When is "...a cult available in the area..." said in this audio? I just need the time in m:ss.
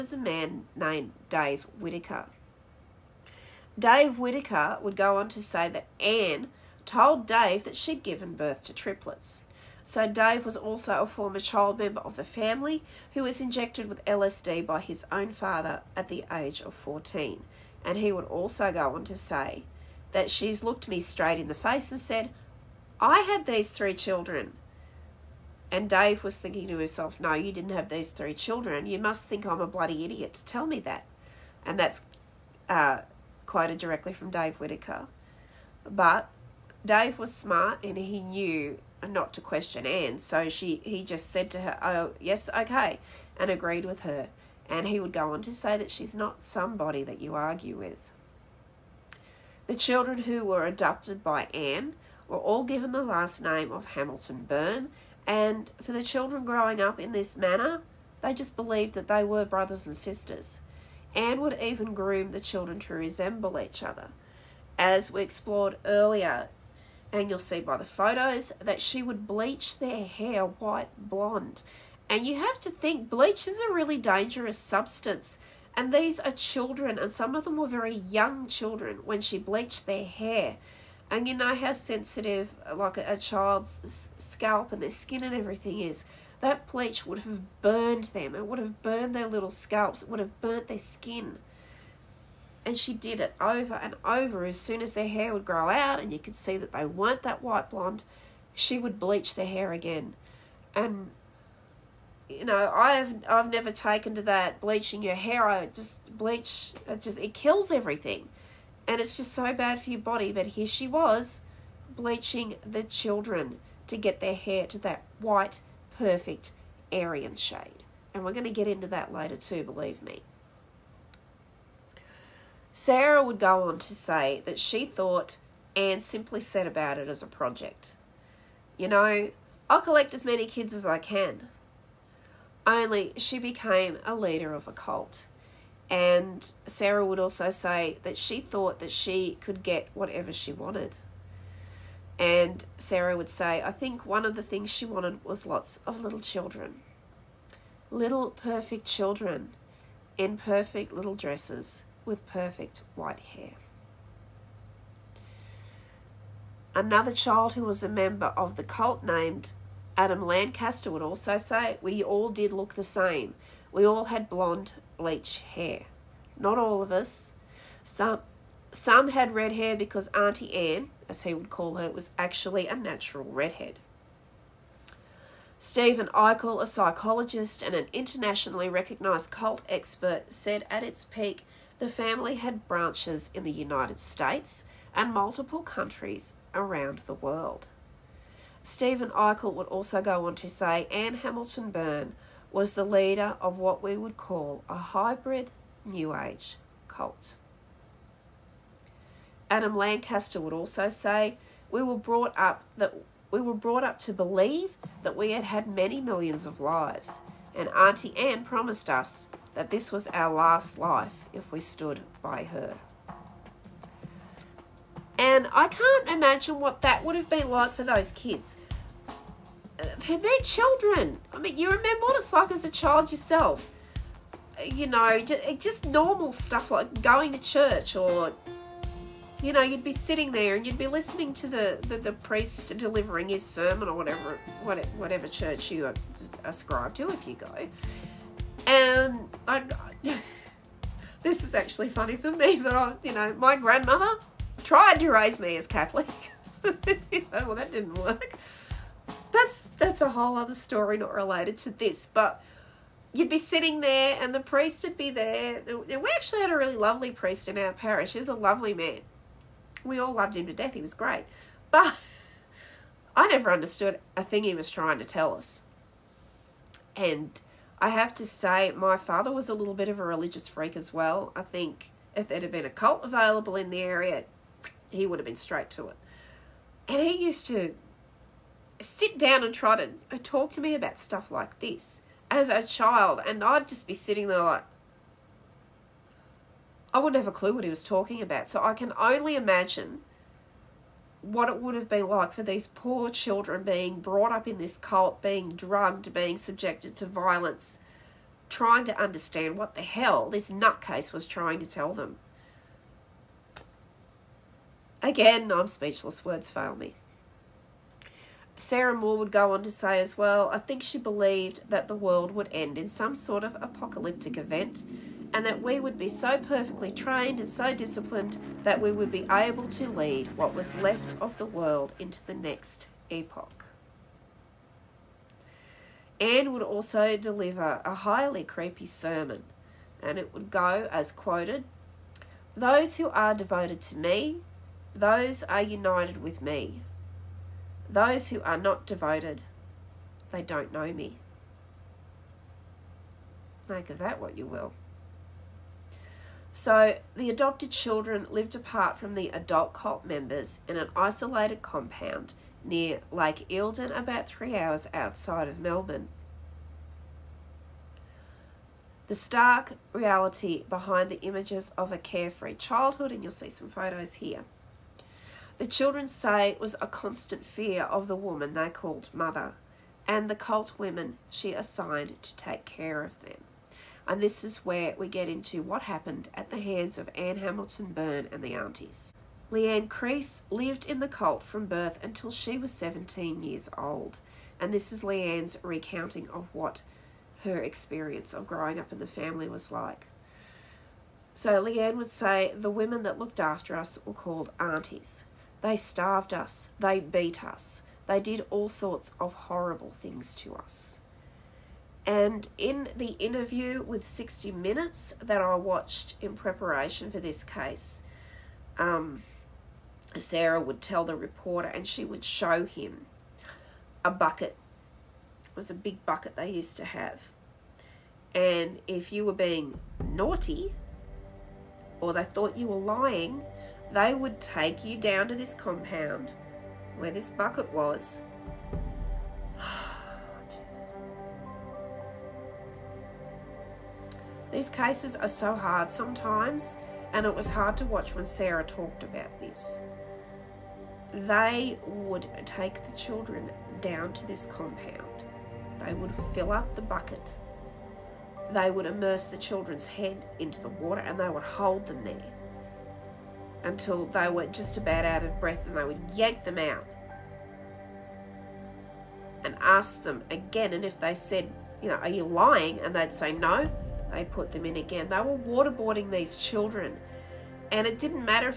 4:32.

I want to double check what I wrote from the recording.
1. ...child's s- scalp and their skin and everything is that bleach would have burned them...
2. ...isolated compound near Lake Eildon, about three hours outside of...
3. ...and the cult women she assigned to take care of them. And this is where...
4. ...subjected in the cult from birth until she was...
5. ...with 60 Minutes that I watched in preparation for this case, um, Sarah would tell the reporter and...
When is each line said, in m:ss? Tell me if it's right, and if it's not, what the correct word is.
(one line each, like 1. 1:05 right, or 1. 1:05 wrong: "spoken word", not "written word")
1. 1:23 right
2. 5:50 right
3. 6:10 right
4. 6:20 wrong: "lived", not "subjected"
5. 6:43 right.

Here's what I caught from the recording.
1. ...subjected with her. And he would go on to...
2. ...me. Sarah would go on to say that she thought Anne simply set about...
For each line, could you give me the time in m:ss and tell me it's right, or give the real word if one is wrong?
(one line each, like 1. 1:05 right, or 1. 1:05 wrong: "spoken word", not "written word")
1. 0:43 wrong: "agreed", not "subjected"
2. 2:00 right.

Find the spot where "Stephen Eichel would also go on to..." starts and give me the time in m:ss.
3:08.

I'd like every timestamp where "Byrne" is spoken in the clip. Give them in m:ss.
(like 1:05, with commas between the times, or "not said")
0:54, 3:11, 6:17.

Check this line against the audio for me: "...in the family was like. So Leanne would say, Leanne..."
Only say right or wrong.
wrong.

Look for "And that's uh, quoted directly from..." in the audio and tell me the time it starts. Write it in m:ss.
0:31.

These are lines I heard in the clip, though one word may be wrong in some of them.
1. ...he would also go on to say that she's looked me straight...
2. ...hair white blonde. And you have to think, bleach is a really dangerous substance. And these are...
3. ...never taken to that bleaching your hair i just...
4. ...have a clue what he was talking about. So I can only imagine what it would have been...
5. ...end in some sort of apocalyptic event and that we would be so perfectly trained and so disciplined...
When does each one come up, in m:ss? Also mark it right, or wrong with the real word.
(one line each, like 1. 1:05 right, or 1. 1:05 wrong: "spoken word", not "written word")
1. 0:17 right
2. 1:10 right
3. 1:43 right
4. 4:47 right
5. 5:12 right.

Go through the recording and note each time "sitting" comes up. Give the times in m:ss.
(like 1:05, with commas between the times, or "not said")
3:49, 4:13, 4:43.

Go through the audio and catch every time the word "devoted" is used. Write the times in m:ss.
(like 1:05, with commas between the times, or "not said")
5:33, 5:38.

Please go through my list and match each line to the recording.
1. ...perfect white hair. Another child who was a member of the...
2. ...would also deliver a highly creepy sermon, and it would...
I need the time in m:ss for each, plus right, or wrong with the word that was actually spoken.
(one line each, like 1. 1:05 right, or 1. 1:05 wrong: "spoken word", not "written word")
1. 2:32 right
2. 5:26 right.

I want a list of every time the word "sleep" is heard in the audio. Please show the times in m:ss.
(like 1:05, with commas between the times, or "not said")
not said.